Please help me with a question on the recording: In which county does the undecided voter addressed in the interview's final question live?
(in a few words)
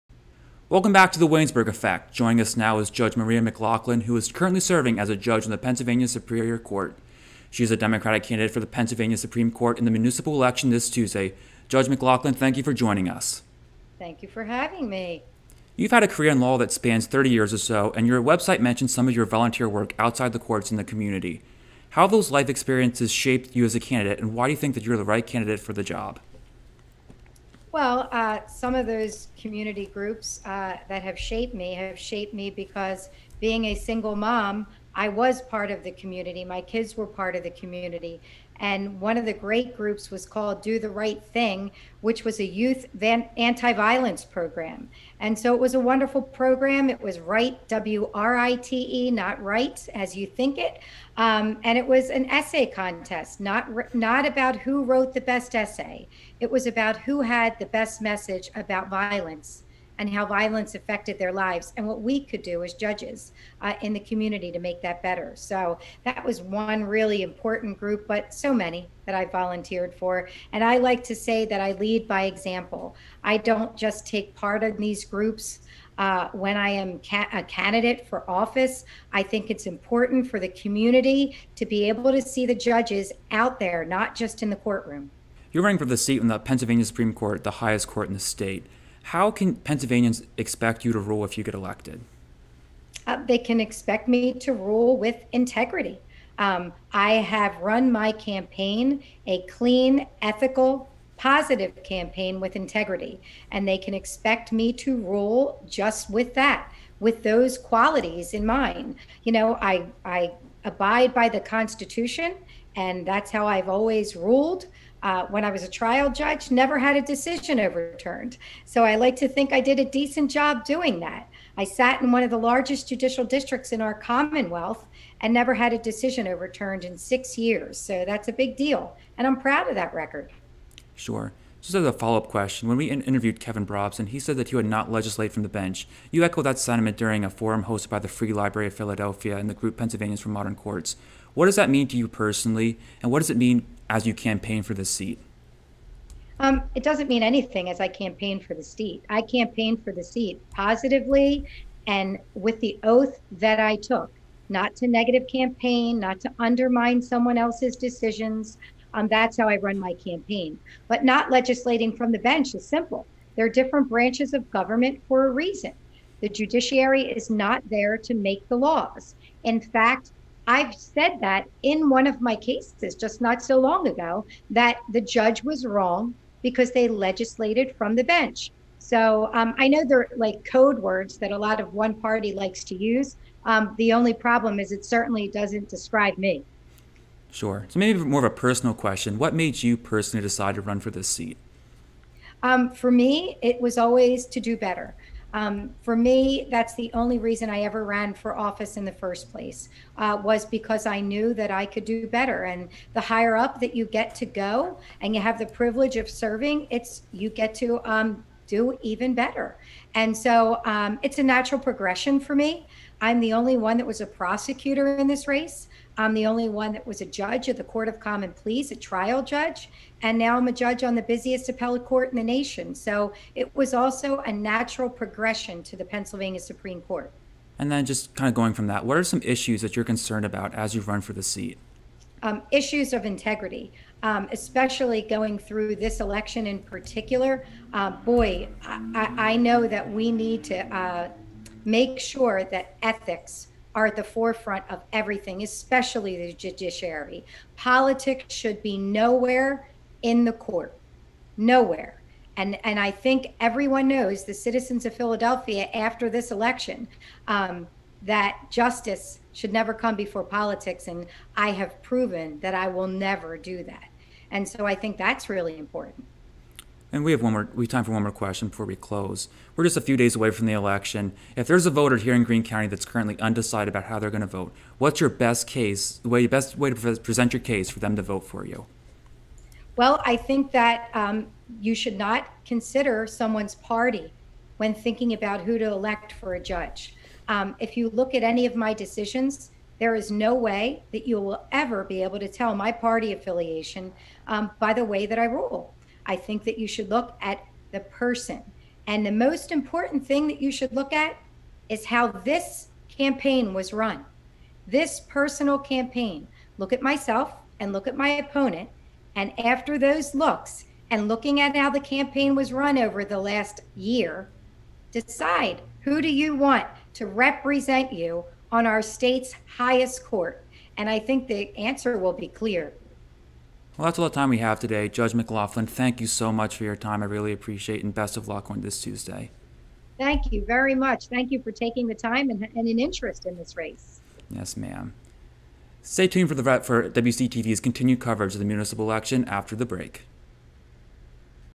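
Greene County.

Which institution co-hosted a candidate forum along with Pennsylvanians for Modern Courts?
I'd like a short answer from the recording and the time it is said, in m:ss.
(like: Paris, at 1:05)
Free Library of Philadelphia, at 2:18.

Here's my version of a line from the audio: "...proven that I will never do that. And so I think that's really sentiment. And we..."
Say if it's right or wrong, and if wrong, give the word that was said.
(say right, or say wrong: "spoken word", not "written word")
wrong: "important", not "sentiment".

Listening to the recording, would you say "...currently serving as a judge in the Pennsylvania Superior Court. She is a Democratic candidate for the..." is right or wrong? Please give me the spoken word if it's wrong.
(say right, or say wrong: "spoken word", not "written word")
right.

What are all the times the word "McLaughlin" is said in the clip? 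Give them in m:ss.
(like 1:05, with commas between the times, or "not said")
0:03, 0:11, 5:25.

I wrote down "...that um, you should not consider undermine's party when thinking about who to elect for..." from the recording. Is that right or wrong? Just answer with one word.
wrong.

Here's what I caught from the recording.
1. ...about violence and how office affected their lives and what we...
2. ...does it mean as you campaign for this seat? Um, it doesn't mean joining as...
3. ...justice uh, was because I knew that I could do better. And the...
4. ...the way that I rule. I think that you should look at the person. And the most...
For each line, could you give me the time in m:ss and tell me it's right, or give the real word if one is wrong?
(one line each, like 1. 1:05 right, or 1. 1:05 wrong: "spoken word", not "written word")
1. 0:58 wrong: "violence", not "office"
2. 2:23 wrong: "anything", not "joining"
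3. 3:19 wrong: "place", not "justice"
4. 4:54 right.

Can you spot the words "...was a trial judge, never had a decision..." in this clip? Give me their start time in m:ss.
1:55.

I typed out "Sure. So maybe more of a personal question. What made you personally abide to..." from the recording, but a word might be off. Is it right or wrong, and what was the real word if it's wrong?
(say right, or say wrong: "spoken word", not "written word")
wrong: "decide", not "abide".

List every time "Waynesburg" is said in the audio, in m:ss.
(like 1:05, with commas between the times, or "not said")
0:01.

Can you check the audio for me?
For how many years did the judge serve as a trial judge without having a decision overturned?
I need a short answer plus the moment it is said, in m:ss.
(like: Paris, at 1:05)
6, at 2:06.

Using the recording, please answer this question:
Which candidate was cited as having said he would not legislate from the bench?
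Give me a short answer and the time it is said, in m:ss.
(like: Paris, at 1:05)
Kevin Brobson, at 2:13.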